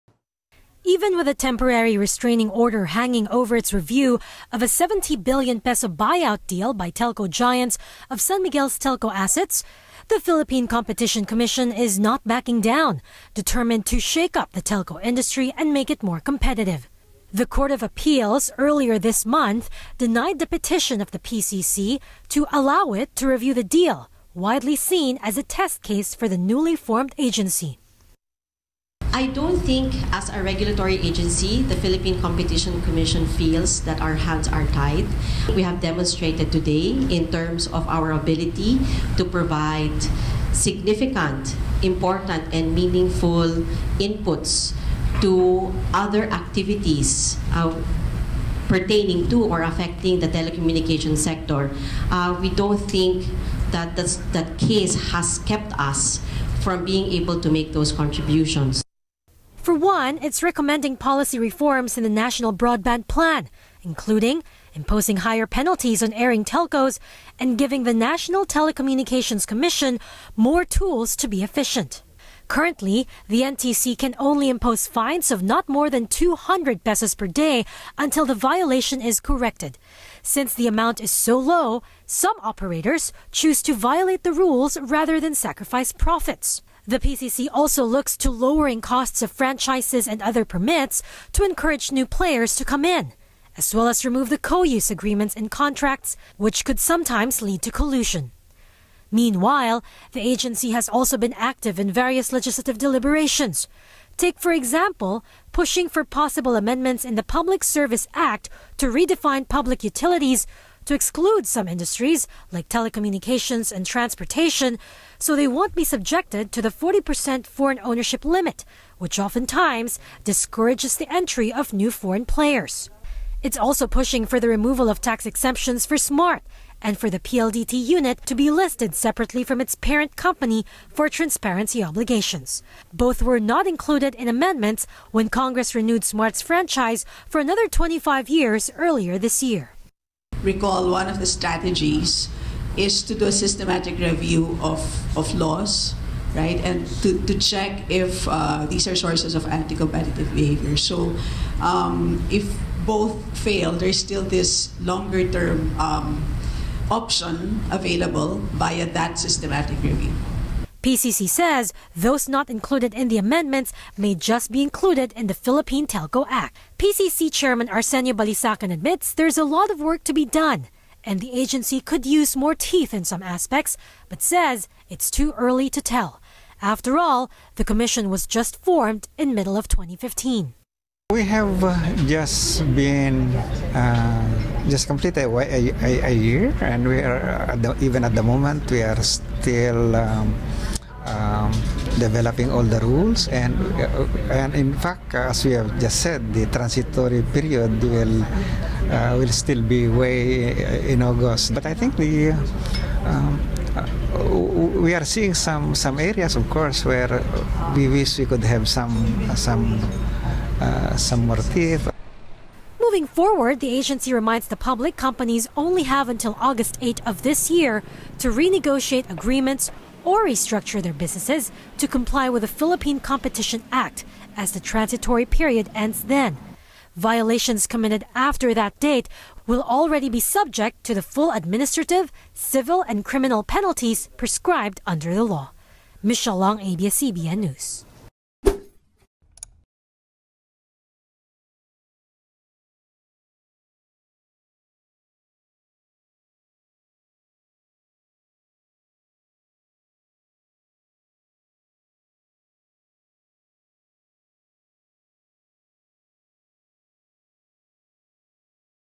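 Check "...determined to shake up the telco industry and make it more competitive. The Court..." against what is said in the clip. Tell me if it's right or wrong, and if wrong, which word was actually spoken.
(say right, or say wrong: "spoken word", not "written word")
right.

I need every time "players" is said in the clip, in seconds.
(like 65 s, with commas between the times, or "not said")
92 s, 122 s.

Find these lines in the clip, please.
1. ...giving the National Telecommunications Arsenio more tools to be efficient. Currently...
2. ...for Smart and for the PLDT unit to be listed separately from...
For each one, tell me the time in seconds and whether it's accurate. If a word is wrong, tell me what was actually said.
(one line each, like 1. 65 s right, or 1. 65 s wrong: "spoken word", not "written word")
1. 67 s wrong: "Commission", not "Arsenio"
2. 125 s right.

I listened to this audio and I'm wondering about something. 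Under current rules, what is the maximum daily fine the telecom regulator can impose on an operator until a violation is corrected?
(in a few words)
200 pesos.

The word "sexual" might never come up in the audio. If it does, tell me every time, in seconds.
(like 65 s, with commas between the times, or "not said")
not said.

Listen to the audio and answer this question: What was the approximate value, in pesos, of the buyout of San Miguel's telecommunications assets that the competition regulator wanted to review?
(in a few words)
70 billion pesos.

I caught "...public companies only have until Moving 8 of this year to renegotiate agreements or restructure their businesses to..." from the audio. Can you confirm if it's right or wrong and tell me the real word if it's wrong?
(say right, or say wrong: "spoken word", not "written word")
wrong: "August", not "Moving".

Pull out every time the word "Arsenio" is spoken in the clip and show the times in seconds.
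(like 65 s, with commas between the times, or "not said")
167 s.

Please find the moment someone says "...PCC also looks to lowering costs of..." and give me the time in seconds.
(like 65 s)
86 s.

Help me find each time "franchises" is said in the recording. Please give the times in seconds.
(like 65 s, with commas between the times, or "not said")
89 s, 136 s.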